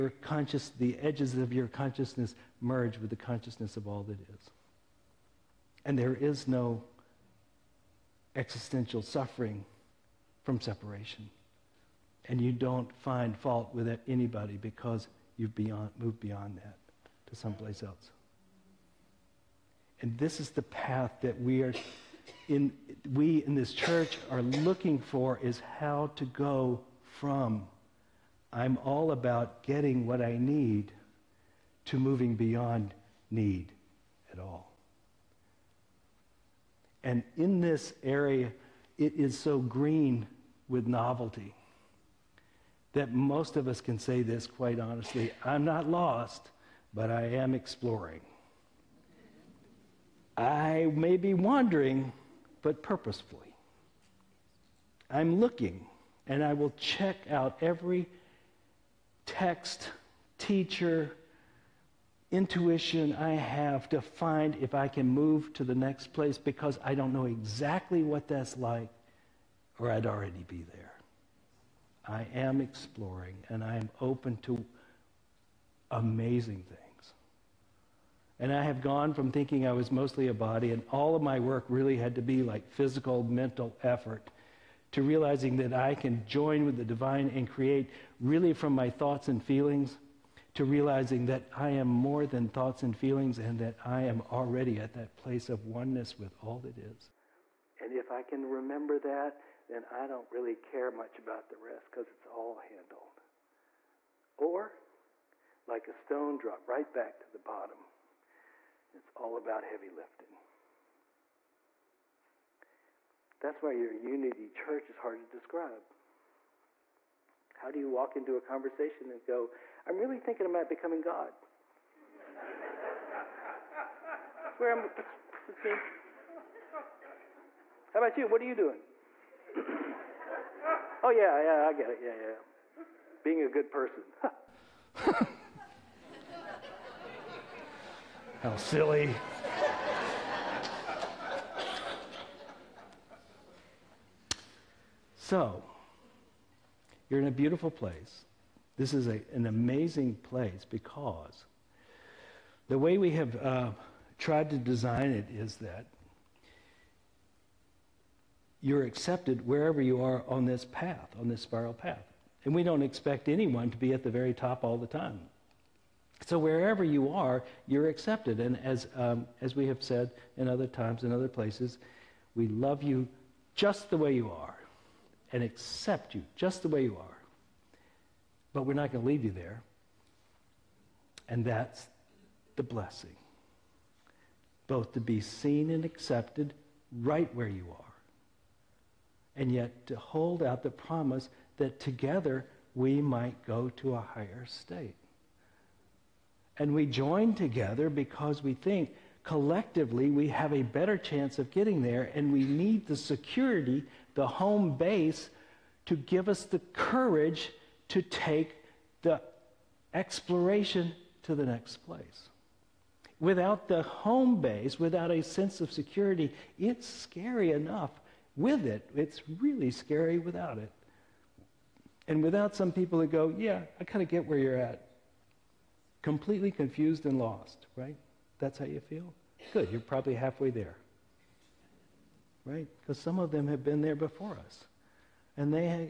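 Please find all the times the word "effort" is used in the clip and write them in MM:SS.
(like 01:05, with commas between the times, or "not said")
01:23.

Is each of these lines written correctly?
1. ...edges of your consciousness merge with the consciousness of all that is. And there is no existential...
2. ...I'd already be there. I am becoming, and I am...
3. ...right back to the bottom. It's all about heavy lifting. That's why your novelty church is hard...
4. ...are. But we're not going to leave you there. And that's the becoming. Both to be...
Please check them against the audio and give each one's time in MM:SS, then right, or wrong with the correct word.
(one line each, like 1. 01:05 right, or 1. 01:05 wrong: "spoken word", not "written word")
1. 00:01 right
2. 01:09 wrong: "exploring", not "becoming"
3. 01:46 wrong: "unity", not "novelty"
4. 02:56 wrong: "blessing", not "becoming".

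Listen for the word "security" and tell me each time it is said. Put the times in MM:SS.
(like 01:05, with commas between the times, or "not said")
03:22, 03:35.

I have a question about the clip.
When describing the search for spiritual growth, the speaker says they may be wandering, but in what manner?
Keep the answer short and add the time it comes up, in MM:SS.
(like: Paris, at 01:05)
purposefully, at 00:52.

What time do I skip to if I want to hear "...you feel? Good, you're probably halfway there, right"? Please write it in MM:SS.
03:48.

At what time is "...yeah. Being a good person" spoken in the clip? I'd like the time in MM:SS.
02:12.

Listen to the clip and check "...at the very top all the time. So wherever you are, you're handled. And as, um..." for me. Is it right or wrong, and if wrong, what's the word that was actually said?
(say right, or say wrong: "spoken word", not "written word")
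wrong: "accepted", not "handled".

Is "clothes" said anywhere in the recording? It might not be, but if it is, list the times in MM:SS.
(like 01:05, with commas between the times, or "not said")
not said.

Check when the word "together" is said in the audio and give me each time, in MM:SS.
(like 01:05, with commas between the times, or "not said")
03:11, 03:17.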